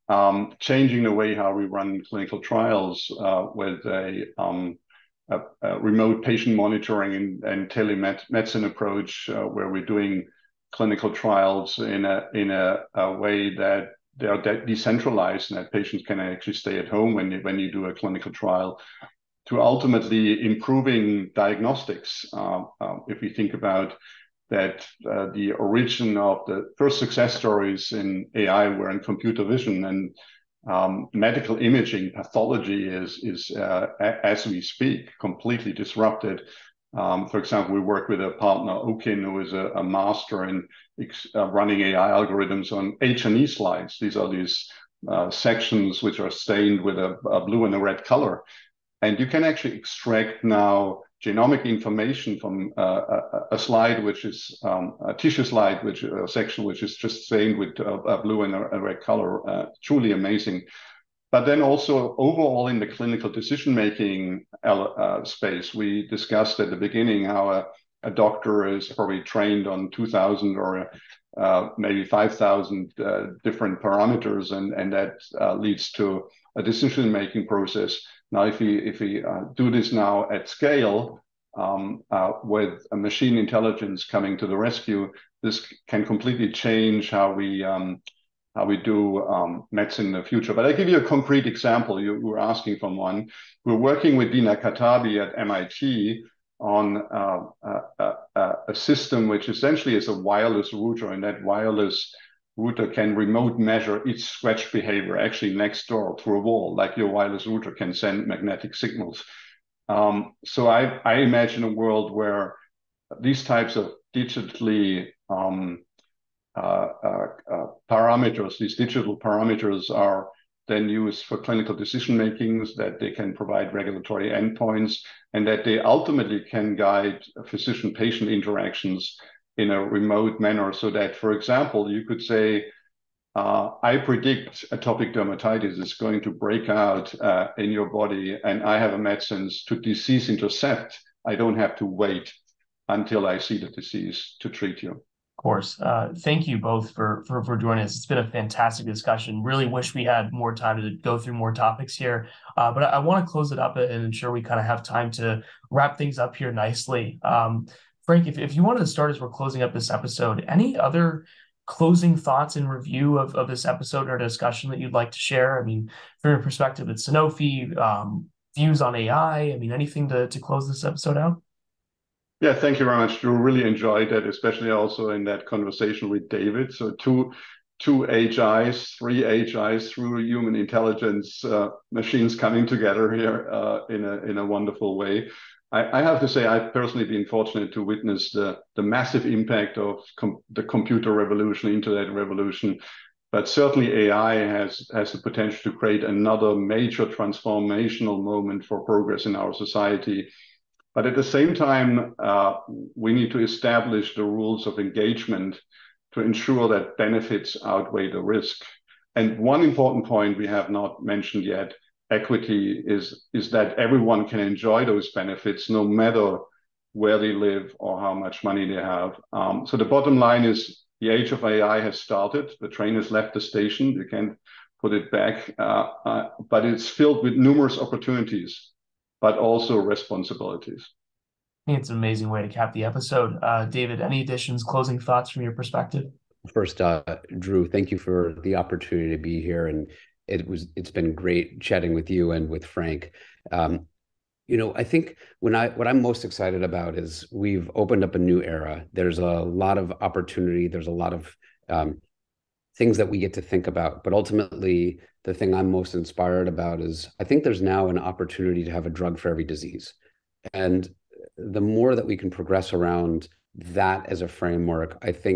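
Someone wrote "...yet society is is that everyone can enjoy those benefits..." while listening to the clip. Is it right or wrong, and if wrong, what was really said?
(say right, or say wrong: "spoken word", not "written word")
wrong: "equity", not "society".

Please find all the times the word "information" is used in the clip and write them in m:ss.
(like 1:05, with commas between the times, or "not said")
0:51.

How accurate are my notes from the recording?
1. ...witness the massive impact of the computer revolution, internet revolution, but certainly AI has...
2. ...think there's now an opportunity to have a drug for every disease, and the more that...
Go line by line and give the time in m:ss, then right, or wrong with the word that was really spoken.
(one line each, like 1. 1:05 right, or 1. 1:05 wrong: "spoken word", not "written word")
1. 3:07 right
2. 4:17 right.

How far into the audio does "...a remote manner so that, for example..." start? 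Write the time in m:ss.
2:09.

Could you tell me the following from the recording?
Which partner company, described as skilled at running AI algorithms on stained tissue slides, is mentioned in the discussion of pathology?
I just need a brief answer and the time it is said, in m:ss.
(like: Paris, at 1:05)
Owkin, at 0:38.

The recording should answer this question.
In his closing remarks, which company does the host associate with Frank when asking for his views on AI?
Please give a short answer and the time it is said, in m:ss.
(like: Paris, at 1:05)
Sanofi, at 2:46.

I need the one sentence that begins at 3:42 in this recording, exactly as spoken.
The train has left the station.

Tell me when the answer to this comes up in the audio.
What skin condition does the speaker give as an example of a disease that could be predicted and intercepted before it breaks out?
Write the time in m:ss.
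2:14.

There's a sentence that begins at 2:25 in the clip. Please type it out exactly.
Uh, thank you both for, for, for joining us.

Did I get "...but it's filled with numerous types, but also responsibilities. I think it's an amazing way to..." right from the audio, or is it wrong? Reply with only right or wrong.
wrong.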